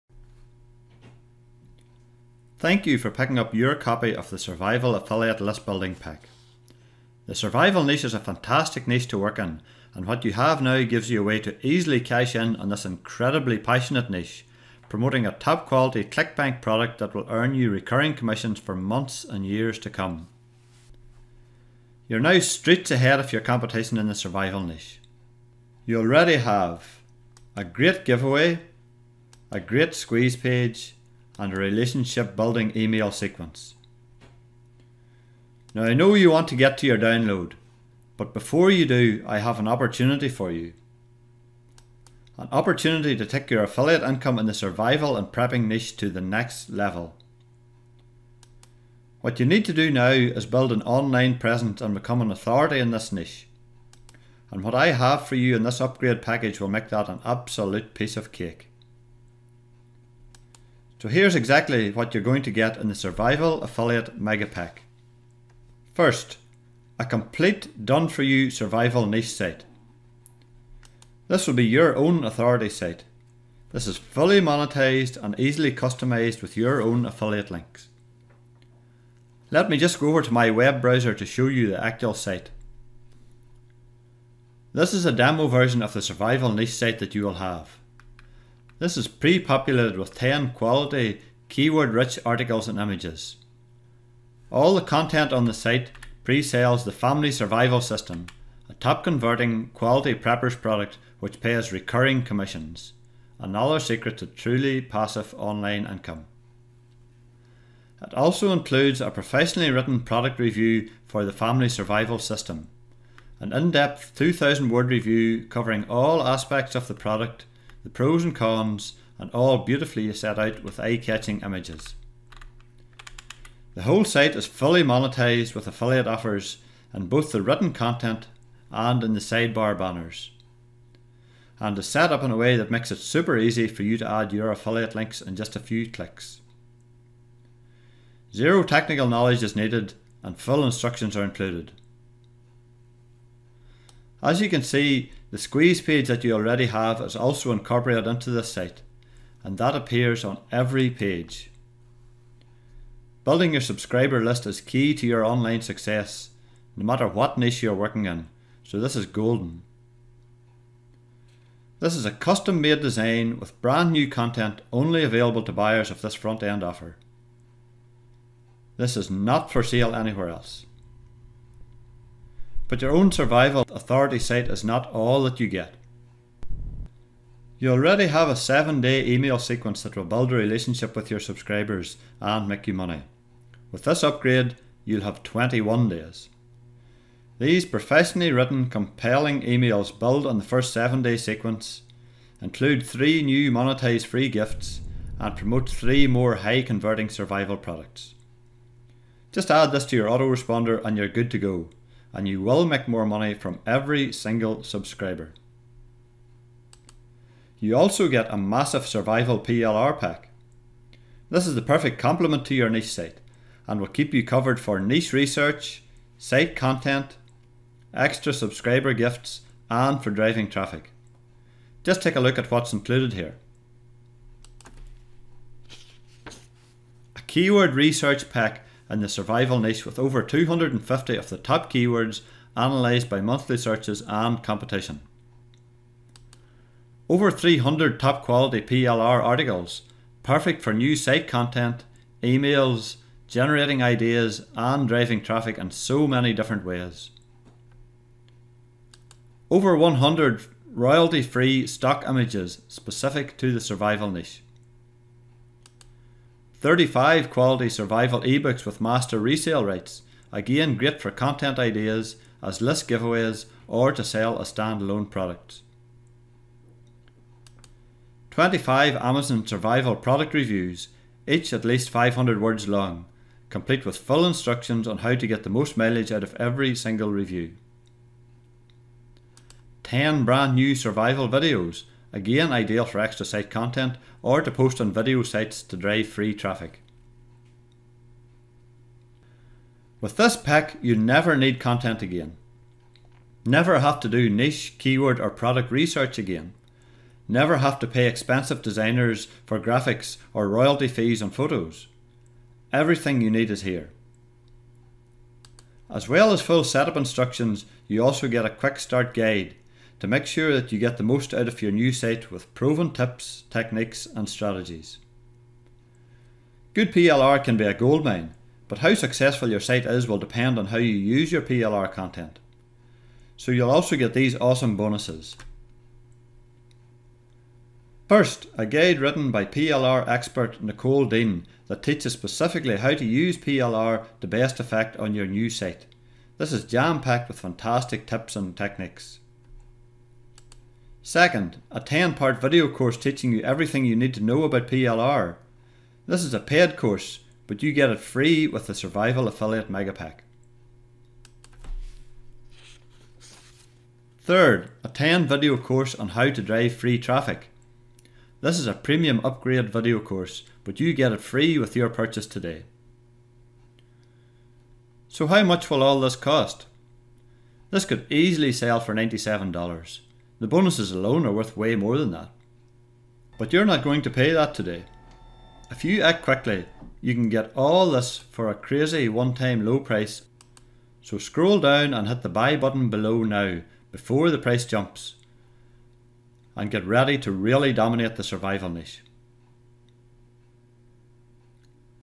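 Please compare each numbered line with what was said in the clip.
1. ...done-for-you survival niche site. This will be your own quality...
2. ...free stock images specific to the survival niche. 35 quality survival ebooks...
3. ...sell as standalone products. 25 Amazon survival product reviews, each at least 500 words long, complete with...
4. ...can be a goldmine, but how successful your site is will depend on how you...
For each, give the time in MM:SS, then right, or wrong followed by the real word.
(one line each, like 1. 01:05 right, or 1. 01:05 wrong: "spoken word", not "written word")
1. 01:07 wrong: "authority", not "quality"
2. 04:11 right
3. 04:24 right
4. 05:17 right.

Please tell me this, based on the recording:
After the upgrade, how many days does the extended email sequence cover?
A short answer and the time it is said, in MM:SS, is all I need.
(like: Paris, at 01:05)
21, at 03:05.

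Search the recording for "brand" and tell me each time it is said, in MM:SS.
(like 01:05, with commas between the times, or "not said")
02:43, 04:40.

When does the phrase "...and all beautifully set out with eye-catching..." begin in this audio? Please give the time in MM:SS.
01:59.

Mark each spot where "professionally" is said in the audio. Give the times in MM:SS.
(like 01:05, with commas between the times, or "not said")
01:49, 03:07.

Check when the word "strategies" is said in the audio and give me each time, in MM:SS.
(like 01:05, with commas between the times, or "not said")
05:14.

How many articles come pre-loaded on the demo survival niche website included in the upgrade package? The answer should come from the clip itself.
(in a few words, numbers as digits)
10.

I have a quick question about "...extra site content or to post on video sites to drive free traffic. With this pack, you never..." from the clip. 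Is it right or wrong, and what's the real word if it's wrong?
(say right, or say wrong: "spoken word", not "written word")
right.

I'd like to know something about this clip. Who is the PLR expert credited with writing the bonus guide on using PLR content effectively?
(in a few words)
Nicole Dean.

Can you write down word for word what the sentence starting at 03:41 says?
Just take a look at what's included here.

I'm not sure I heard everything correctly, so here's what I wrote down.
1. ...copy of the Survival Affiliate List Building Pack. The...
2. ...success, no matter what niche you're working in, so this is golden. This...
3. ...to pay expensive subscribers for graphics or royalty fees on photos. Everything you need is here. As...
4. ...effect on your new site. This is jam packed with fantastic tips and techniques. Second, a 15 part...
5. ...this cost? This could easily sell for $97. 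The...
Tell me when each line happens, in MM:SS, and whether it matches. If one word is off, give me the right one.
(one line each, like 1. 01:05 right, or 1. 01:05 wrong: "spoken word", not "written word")
1. 00:03 right
2. 02:35 right
3. 04:57 wrong: "designers", not "subscribers"
4. 05:34 wrong: "10", not "15"
5. 06:05 right.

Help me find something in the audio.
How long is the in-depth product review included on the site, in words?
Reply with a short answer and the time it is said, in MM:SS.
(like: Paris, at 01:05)
2,000, at 01:54.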